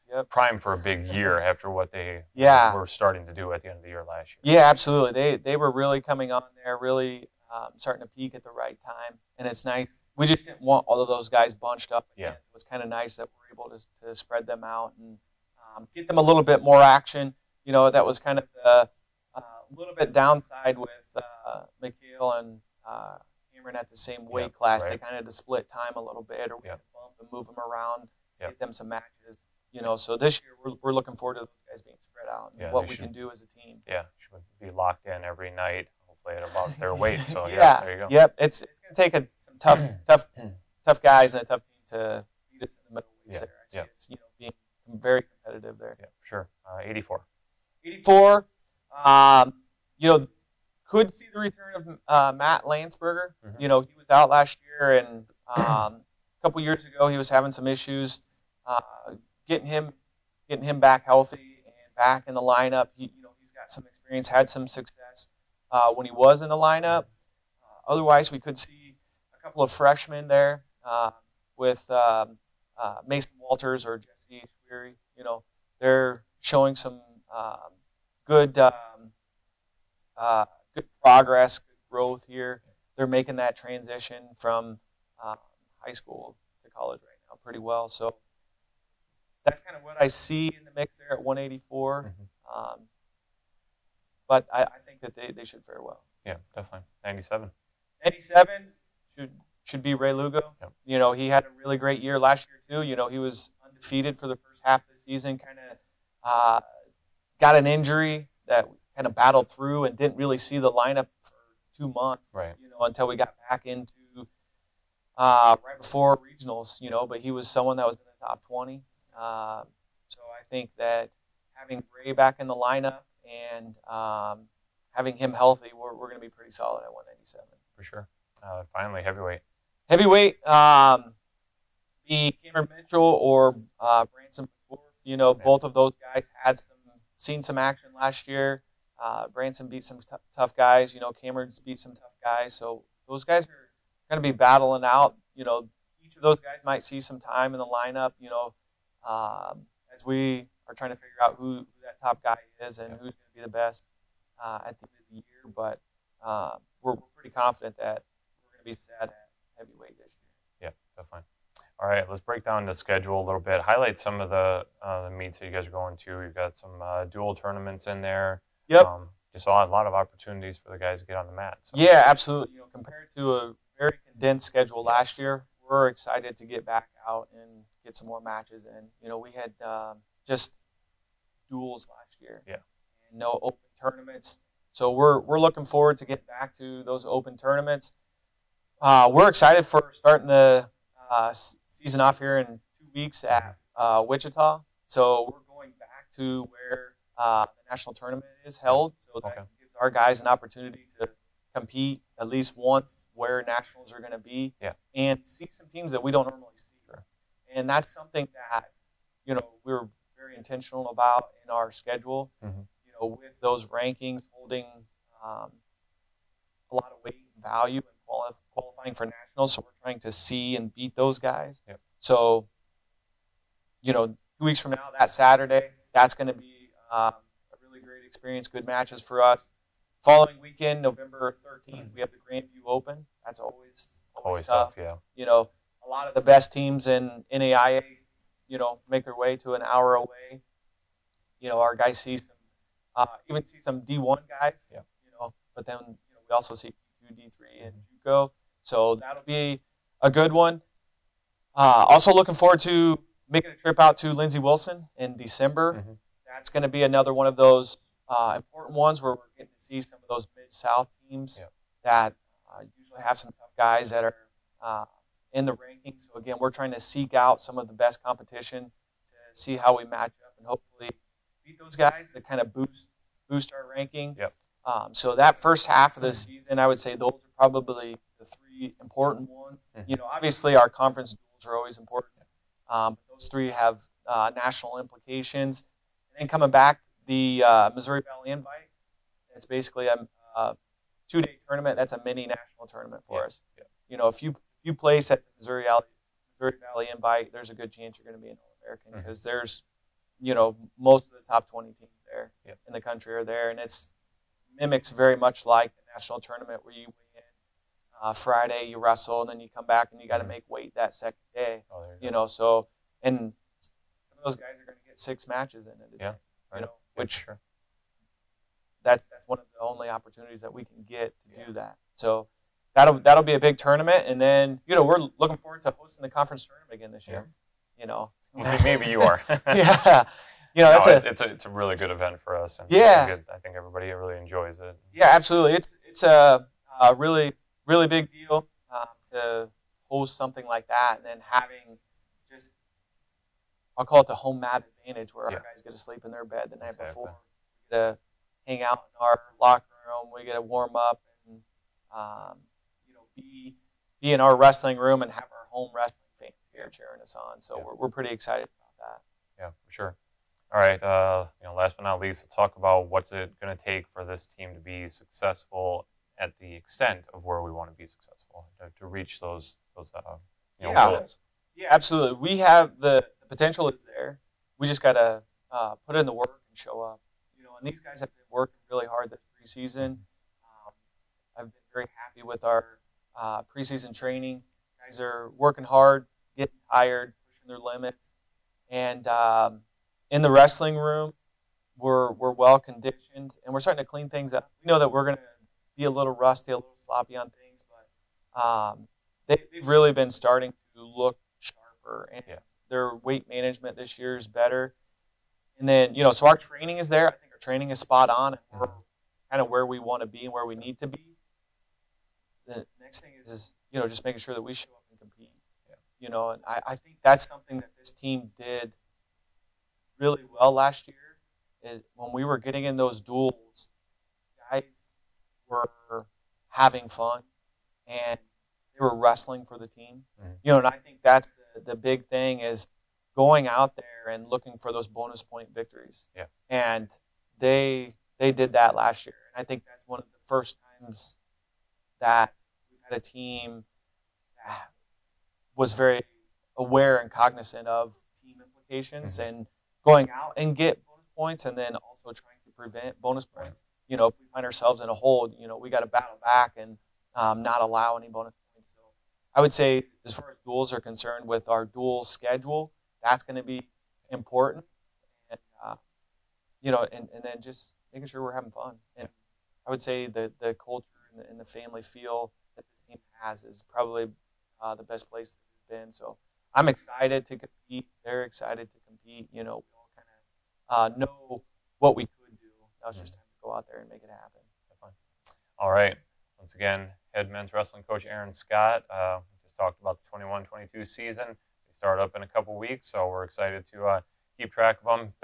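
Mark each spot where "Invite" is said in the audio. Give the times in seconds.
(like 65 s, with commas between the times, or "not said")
288 s, 296 s.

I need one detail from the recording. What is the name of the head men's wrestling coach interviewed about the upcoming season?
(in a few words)
Aaron Scott.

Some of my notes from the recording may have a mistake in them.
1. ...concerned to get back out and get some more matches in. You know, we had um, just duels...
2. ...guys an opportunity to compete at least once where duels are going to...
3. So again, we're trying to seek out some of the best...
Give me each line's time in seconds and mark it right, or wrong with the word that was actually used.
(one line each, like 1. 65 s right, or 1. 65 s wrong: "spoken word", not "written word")
1. 175 s wrong: "excited", not "concerned"
2. 199 s wrong: "nationals", not "duels"
3. 266 s right.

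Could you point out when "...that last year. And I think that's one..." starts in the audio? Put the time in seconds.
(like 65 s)
438 s.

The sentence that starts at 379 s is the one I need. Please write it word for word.
Um, I've been very happy with our uh, preseason training.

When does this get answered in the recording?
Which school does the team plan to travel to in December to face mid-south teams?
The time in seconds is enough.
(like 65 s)
254 s.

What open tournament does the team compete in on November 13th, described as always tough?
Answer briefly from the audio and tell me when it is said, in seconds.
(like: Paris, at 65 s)
Grandview Open, at 232 s.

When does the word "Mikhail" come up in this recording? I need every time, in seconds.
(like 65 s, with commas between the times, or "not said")
21 s.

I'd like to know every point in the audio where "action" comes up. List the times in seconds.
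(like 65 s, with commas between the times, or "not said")
16 s, 137 s.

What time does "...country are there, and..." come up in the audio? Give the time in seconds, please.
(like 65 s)
302 s.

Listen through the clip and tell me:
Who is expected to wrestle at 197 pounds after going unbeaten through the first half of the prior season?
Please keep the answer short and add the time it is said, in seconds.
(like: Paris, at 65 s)
Ray Lugo, at 99 s.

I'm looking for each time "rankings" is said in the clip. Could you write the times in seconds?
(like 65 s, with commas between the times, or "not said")
213 s, 265 s, 273 s.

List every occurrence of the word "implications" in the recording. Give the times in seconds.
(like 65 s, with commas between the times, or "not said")
284 s, 448 s.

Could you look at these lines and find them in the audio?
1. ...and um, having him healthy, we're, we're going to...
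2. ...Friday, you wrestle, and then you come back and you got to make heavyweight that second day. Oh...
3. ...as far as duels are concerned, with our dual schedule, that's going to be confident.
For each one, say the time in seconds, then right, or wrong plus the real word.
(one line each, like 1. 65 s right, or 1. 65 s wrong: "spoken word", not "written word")
1. 123 s right
2. 308 s wrong: "weight", not "heavyweight"
3. 460 s wrong: "important", not "confident".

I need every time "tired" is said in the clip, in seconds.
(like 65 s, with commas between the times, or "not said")
386 s.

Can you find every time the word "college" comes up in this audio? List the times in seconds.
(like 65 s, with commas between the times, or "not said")
86 s.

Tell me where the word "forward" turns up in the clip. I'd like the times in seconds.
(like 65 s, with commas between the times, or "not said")
31 s, 185 s, 252 s, 325 s.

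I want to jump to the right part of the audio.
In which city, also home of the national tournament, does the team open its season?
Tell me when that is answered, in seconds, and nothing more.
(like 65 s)
194 s.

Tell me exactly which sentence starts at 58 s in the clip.
Uh, getting him, getting him back healthy and back in the lineup.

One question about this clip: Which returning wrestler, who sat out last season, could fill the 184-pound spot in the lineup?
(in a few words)
Matt Landsberger.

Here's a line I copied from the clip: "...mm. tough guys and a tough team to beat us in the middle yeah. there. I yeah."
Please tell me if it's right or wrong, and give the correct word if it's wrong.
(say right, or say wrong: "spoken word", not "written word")
right.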